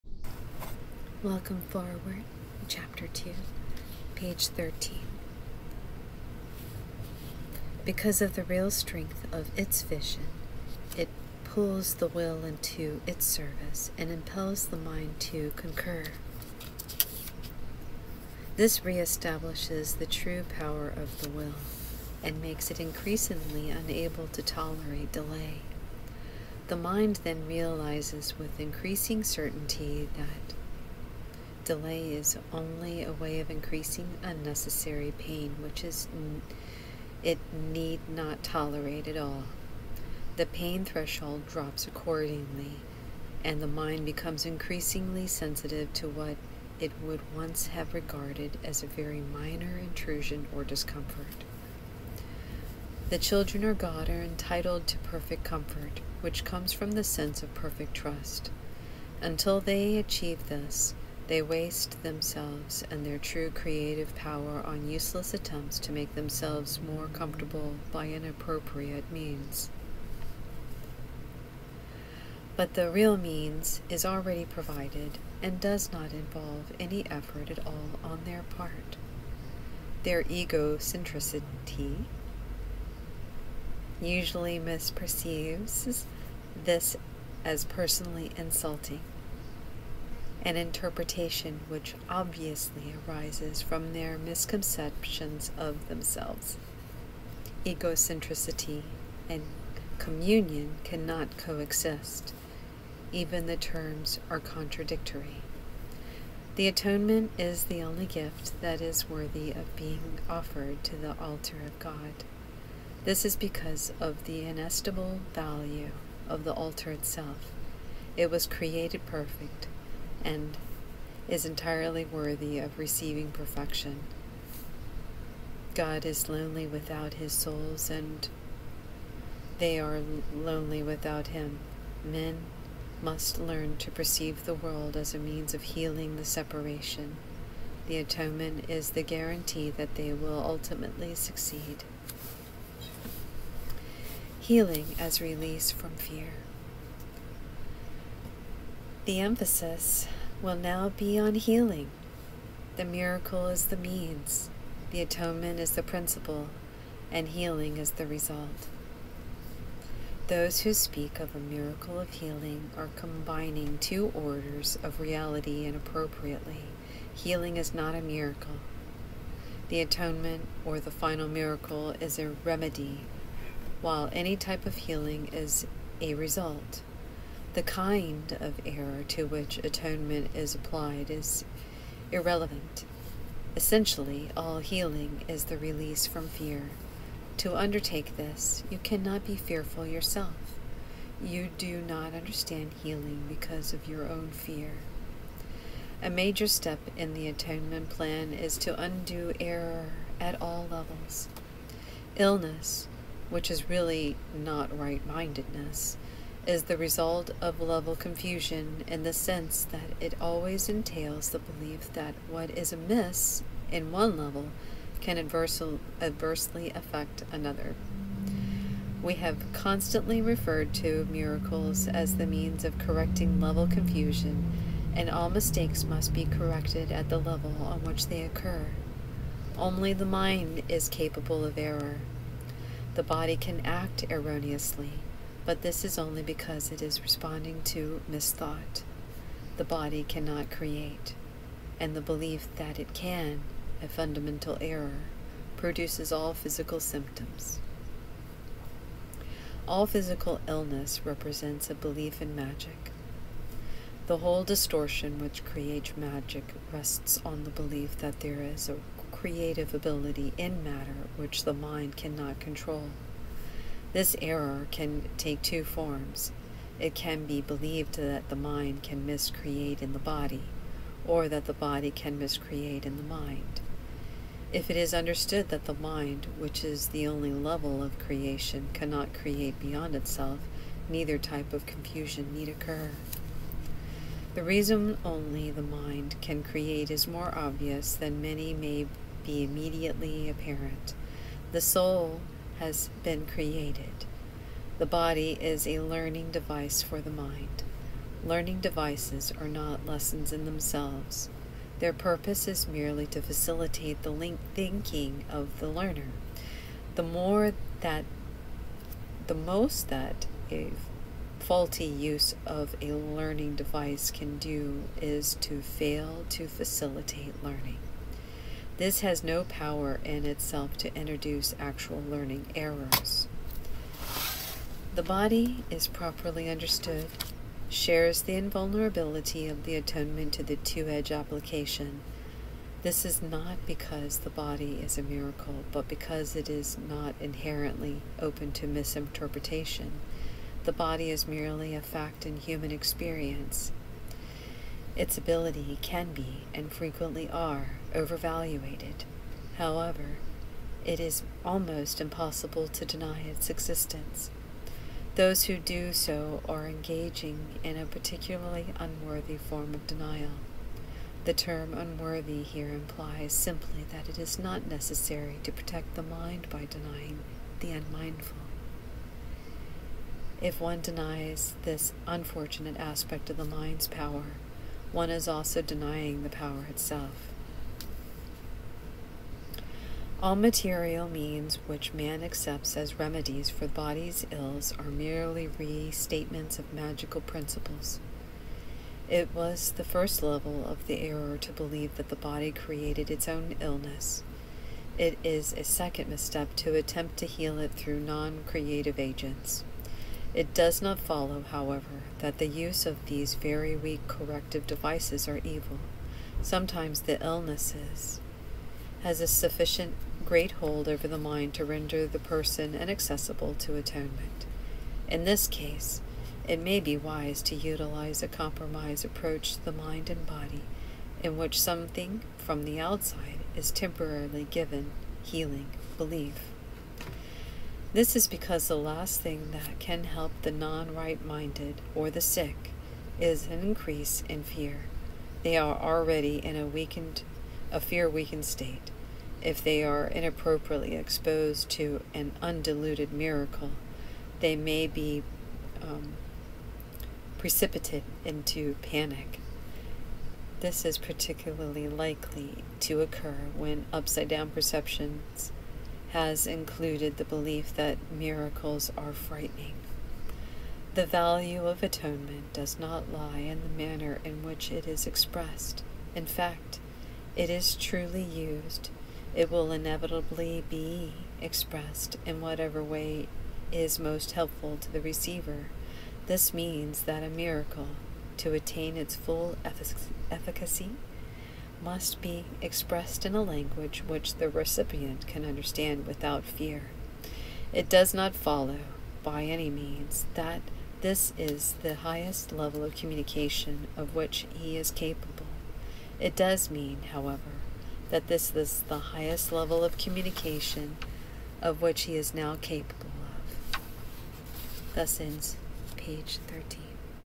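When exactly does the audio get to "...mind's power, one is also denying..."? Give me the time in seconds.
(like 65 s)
373 s.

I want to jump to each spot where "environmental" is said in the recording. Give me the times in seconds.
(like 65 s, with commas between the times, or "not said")
not said.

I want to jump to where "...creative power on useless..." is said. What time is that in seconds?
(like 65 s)
63 s.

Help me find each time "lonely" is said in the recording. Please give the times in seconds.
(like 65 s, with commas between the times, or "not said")
126 s, 130 s.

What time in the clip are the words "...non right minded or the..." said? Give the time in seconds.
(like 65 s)
430 s.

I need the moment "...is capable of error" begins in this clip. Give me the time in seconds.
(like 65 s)
230 s.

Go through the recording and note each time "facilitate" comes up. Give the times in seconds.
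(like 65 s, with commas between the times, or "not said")
303 s, 316 s.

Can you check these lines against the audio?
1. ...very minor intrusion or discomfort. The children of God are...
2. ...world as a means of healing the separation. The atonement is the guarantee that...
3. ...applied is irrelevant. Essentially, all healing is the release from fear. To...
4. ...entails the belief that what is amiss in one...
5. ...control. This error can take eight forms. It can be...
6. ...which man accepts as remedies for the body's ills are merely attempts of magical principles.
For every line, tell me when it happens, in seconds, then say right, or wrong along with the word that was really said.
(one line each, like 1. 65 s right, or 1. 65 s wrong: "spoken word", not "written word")
1. 48 s right
2. 134 s right
3. 180 s right
4. 210 s right
5. 262 s wrong: "two", not "eight"
6. 381 s wrong: "restatements", not "attempts".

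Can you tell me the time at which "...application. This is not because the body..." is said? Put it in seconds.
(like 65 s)
331 s.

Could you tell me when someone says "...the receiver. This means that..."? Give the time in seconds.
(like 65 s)
474 s.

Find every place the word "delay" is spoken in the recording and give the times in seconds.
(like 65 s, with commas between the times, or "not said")
25 s, 31 s.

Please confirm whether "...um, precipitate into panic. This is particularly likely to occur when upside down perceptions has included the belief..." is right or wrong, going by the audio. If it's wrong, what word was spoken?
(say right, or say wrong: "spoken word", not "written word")
right.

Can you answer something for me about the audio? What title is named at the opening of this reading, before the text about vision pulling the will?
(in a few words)
Welcome Forward.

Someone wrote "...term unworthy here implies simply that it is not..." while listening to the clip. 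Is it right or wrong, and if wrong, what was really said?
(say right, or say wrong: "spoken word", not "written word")
right.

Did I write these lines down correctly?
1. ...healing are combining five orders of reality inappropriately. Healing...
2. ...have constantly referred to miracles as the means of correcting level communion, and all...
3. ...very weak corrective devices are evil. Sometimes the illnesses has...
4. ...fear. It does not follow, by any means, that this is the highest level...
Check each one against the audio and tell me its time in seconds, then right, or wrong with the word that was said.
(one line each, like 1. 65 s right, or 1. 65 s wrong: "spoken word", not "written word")
1. 162 s wrong: "two", not "five"
2. 219 s wrong: "confusion", not "communion"
3. 403 s right
4. 486 s right.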